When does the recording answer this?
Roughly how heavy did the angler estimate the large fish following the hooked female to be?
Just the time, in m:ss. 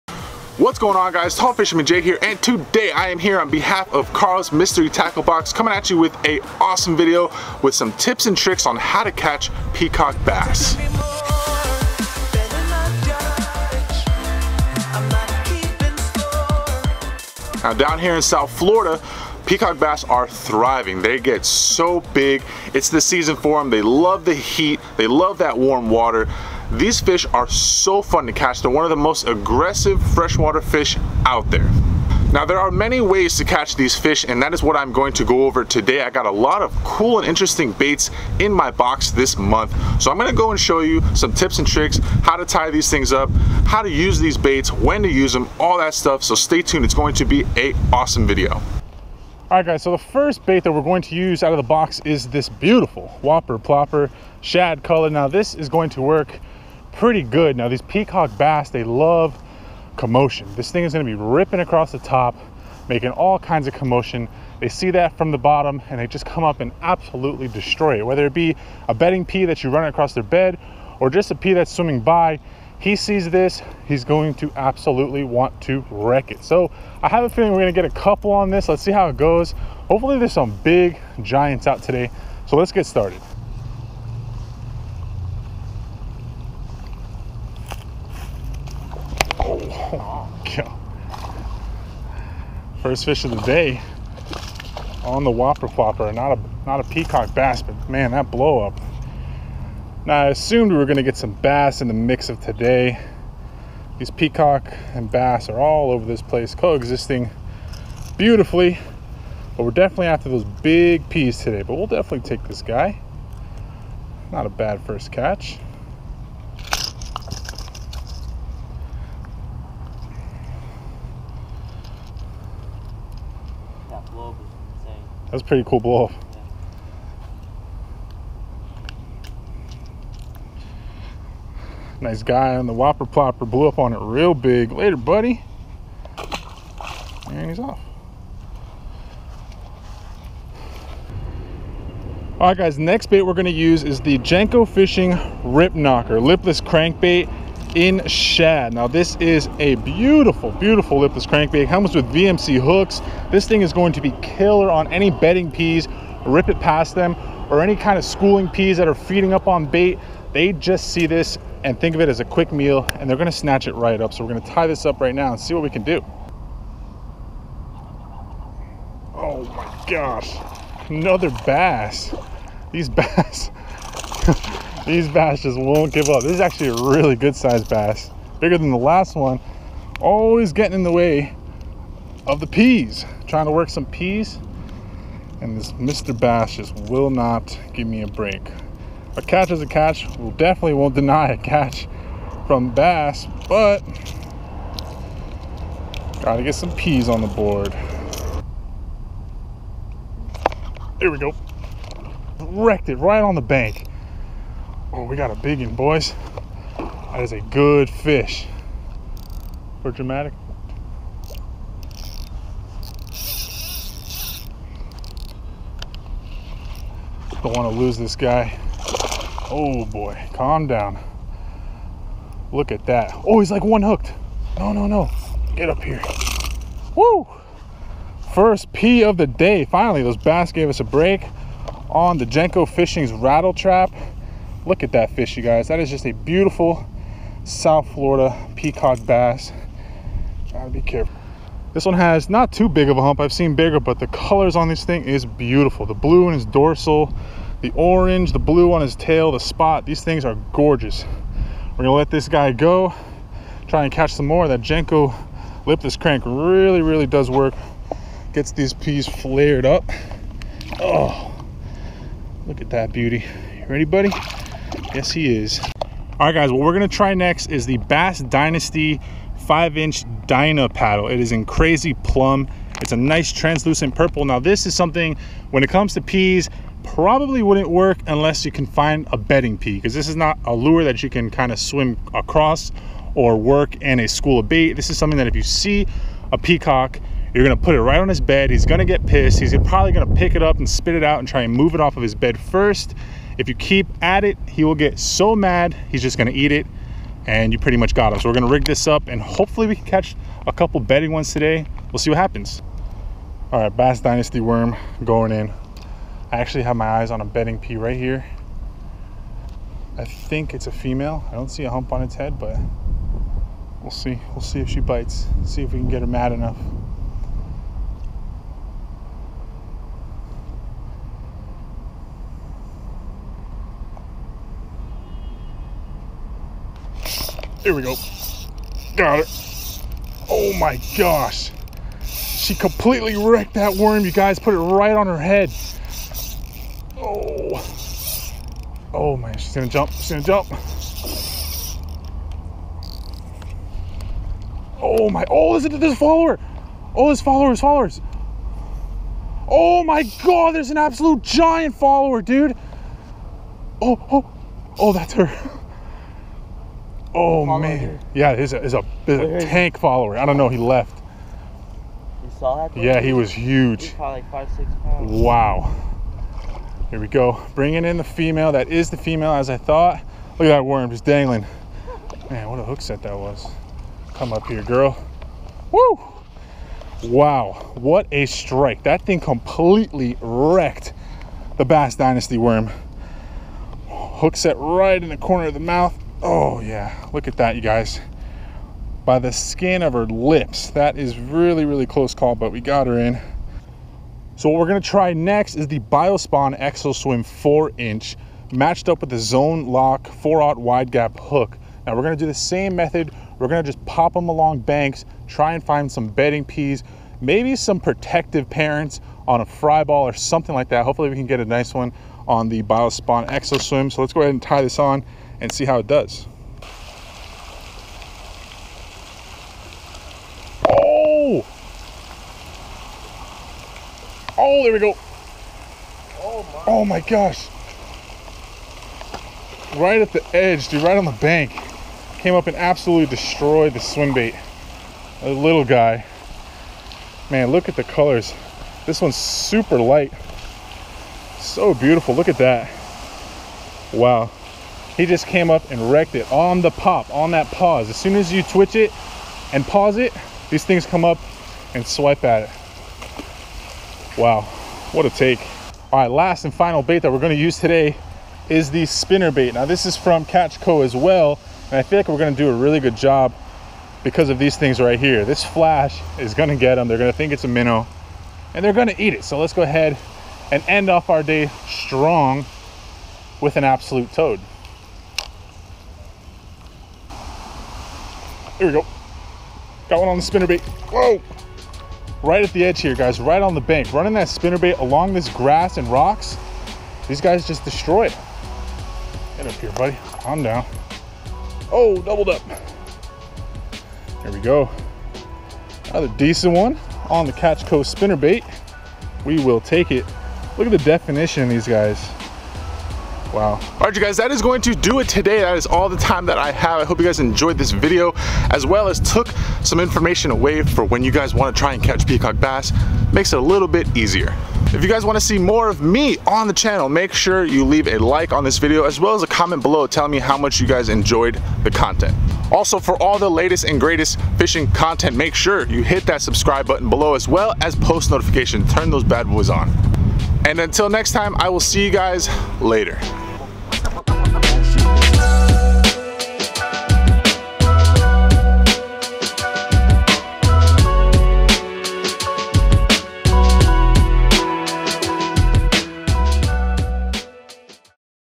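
6:04.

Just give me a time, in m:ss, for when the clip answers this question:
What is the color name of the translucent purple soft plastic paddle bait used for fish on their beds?
4:31.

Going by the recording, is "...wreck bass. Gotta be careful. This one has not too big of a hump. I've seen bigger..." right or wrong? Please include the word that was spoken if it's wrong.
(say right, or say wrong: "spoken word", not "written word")
wrong: "peacock", not "wreck".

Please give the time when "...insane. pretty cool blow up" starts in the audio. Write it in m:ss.
2:05.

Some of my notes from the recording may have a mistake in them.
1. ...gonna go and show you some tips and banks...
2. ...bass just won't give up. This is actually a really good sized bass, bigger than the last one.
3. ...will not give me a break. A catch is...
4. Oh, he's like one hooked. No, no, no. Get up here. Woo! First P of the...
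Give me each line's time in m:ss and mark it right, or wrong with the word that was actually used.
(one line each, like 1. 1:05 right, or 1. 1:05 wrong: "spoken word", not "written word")
1. 0:40 wrong: "tricks", not "banks"
2. 2:55 right
3. 3:06 right
4. 3:43 right.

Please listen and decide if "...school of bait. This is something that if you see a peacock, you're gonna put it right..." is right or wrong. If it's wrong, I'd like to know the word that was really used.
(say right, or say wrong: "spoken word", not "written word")
right.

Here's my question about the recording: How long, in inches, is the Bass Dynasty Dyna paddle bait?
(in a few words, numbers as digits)
5 inches.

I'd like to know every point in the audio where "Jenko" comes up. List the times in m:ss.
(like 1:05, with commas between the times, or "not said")
2:24, 3:52, 4:14.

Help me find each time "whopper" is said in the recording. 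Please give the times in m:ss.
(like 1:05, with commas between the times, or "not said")
0:53, 1:35, 2:12.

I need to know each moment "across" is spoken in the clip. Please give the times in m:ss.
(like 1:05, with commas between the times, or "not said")
1:01, 1:09, 4:42.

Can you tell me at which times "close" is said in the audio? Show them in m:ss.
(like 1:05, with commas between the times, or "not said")
6:31.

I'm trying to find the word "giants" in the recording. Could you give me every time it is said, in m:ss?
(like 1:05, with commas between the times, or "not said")
1:21, 5:51.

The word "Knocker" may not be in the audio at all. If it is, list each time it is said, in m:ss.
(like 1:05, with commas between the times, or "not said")
2:25.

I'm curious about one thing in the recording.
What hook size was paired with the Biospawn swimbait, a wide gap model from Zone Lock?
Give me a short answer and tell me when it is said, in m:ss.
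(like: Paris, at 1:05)
4/0, at 6:40.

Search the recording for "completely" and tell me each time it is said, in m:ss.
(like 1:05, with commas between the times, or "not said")
5:32, 6:19.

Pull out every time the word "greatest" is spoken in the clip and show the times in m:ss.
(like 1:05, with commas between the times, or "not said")
8:43.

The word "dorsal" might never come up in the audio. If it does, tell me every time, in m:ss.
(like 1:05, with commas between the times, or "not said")
4:06.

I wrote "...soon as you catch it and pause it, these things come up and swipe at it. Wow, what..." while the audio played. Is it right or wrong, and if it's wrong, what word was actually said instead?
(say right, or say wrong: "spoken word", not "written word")
wrong: "twitch", not "catch".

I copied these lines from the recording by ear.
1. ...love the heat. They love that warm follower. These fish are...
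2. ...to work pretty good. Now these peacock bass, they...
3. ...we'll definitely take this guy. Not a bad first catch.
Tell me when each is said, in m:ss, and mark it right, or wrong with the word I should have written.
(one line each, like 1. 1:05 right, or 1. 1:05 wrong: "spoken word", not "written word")
1. 0:23 wrong: "water", not "follower"
2. 0:55 right
3. 1:51 right.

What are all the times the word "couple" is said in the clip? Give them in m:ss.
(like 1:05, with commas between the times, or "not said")
1:17, 5:00.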